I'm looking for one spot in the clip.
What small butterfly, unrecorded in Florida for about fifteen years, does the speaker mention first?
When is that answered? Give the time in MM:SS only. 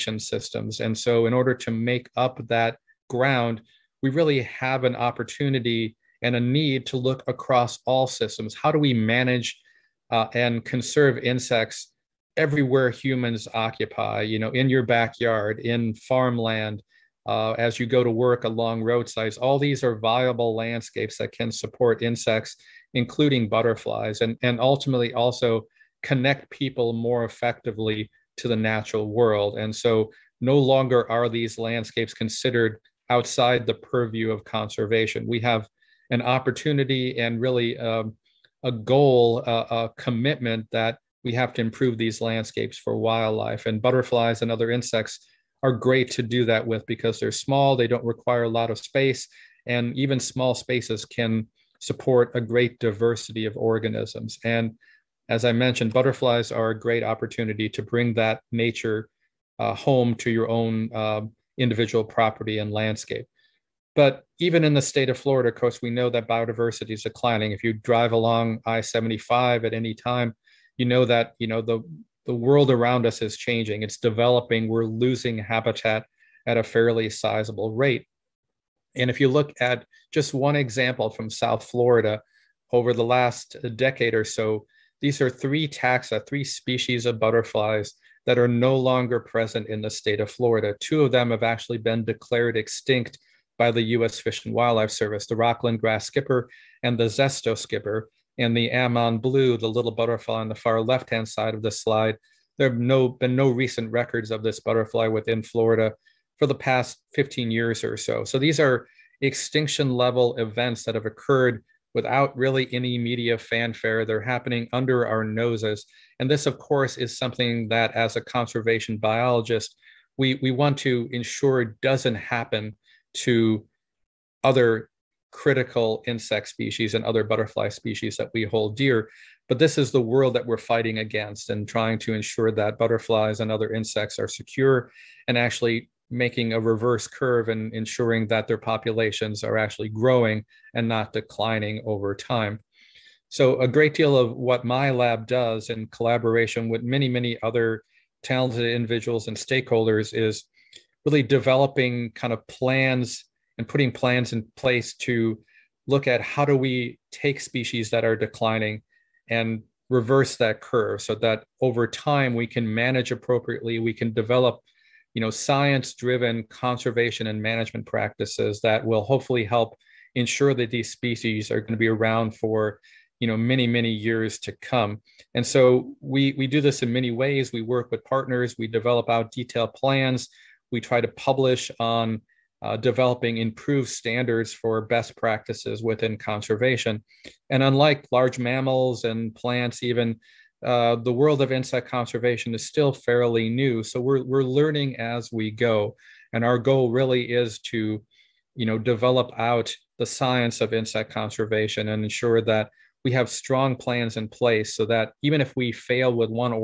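01:38.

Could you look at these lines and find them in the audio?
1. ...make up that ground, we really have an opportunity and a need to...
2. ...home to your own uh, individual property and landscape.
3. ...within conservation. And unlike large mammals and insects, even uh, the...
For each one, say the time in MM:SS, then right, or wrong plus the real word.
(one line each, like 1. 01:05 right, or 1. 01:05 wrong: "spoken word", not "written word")
1. 00:01 right
2. 00:59 right
3. 03:05 wrong: "plants", not "insects".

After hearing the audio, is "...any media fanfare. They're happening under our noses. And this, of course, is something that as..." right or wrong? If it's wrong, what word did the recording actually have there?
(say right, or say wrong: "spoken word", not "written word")
right.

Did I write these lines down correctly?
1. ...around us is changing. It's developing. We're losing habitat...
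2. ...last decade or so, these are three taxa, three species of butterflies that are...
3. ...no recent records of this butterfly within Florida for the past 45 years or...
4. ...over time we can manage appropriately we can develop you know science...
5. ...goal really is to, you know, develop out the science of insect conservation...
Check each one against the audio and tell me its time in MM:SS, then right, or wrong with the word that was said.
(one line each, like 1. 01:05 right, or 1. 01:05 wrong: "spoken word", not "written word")
1. 01:12 right
2. 01:23 right
3. 01:43 wrong: "15", not "45"
4. 02:41 right
5. 03:16 right.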